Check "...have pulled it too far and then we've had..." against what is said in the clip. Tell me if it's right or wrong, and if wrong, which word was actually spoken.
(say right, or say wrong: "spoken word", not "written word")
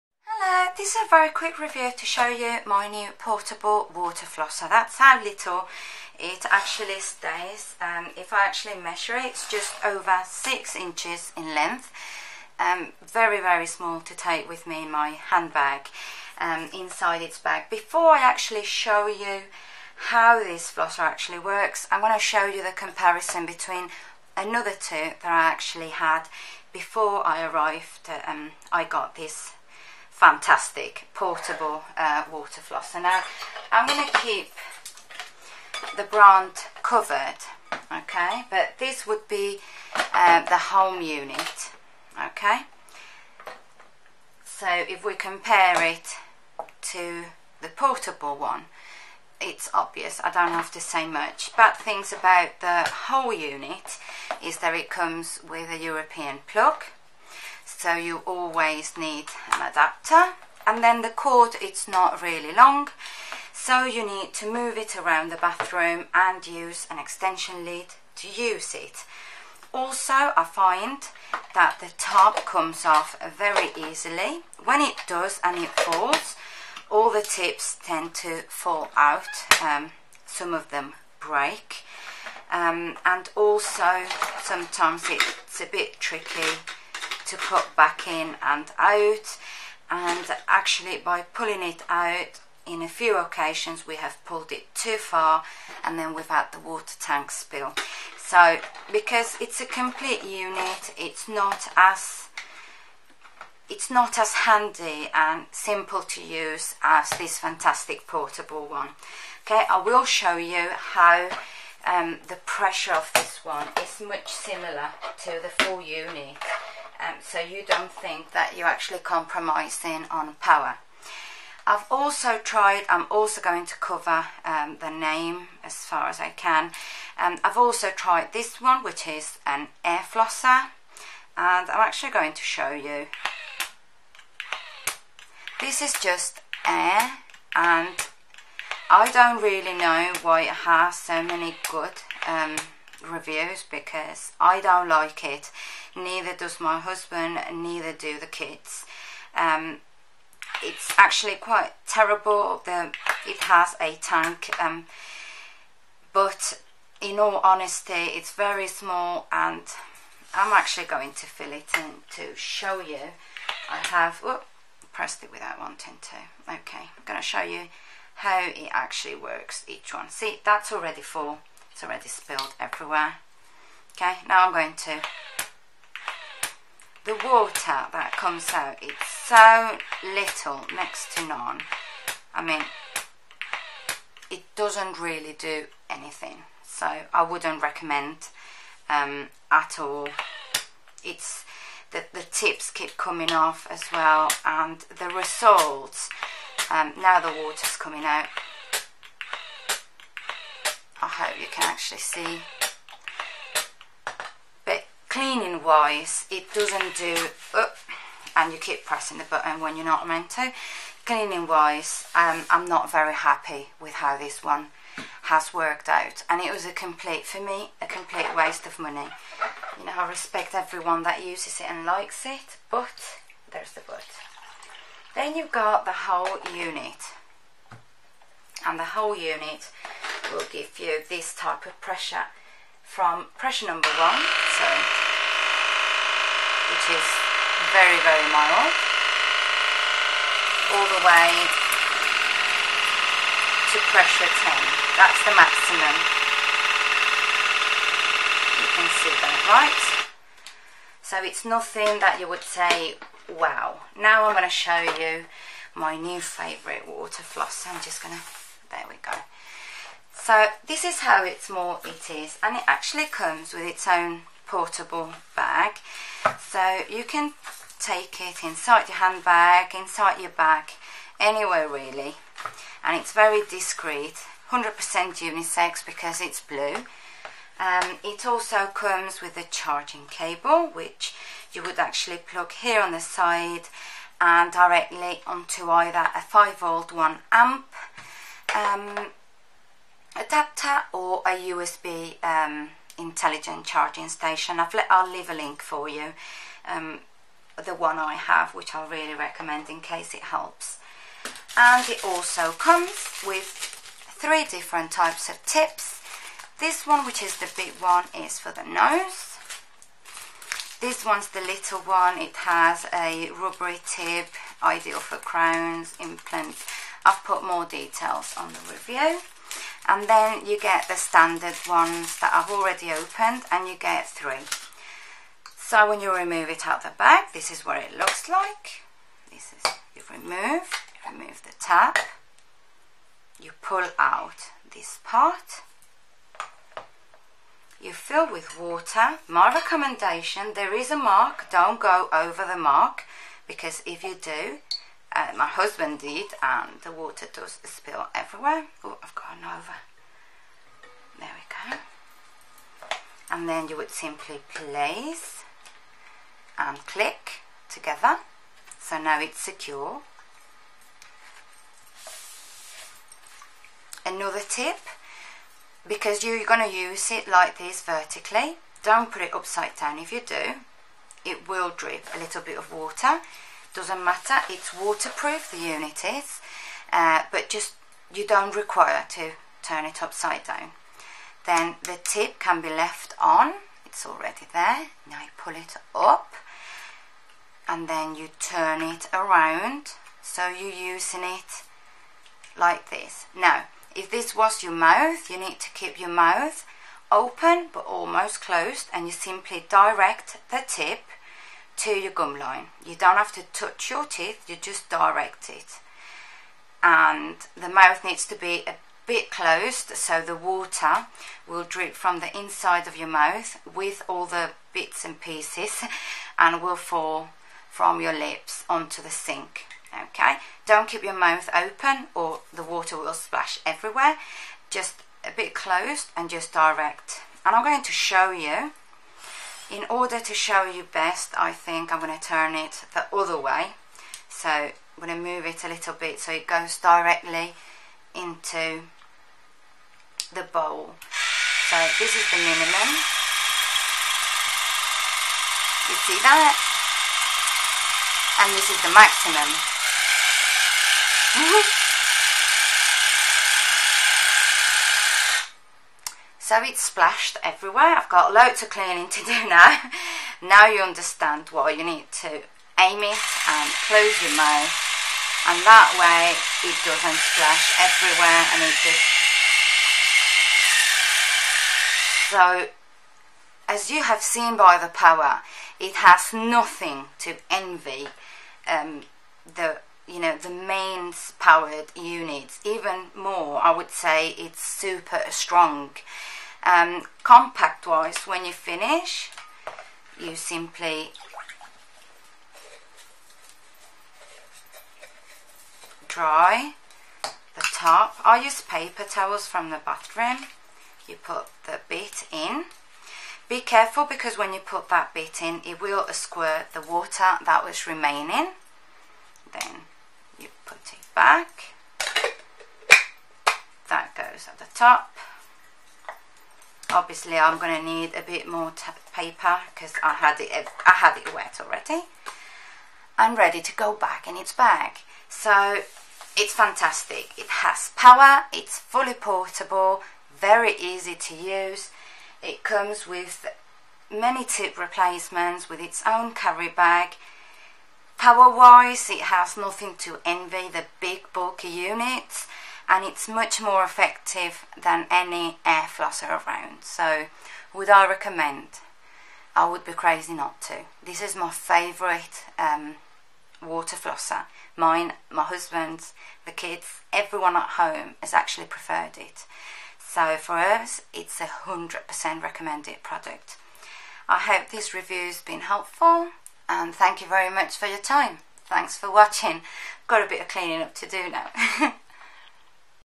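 right.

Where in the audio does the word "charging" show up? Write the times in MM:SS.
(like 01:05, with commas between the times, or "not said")
04:39, 04:53.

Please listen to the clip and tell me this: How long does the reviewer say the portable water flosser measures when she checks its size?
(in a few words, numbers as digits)
just over 6 inches.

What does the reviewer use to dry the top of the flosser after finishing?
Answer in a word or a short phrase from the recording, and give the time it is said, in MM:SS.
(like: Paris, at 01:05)
paper towels, at 08:18.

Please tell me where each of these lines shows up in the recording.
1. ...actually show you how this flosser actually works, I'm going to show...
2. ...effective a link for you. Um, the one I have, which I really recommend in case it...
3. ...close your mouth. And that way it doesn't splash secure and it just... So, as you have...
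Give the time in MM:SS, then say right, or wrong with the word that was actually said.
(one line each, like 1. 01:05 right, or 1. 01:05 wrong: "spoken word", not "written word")
1. 00:18 right
2. 04:55 wrong: "leave", not "effective"
3. 07:43 wrong: "everywhere", not "secure".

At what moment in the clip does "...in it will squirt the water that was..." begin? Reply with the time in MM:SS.
08:25.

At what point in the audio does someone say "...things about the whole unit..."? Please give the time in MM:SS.
00:51.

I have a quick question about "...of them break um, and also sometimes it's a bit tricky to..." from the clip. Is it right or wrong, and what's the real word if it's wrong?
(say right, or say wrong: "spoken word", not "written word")
right.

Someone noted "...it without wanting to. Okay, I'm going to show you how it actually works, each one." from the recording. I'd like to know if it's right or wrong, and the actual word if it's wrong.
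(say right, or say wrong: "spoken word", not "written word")
right.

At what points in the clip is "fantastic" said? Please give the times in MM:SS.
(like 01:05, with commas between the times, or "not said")
00:30, 01:47, 08:46.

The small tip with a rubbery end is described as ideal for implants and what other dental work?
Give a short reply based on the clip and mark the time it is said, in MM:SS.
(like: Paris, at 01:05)
crowns, at 05:15.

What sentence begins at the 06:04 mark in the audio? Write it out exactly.
Another tip, because you're going to use it like this vertically, don't put it upside down if you do.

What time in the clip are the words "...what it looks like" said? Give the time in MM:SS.
05:27.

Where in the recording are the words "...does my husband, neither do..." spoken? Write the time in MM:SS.
02:26.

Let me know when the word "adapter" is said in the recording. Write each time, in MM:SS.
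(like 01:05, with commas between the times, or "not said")
00:59, 04:50.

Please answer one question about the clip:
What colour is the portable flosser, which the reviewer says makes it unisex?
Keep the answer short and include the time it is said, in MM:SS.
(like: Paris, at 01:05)
blue, at 04:36.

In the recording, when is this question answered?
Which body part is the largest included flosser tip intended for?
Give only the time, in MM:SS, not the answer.
05:08.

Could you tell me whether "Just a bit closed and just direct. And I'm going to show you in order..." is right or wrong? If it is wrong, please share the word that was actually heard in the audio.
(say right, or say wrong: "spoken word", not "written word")
right.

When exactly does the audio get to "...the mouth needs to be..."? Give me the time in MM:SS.
06:47.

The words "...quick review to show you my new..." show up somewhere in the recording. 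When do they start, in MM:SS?
00:01.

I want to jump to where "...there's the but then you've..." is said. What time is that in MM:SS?
03:43.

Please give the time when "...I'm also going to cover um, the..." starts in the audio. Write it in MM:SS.
02:02.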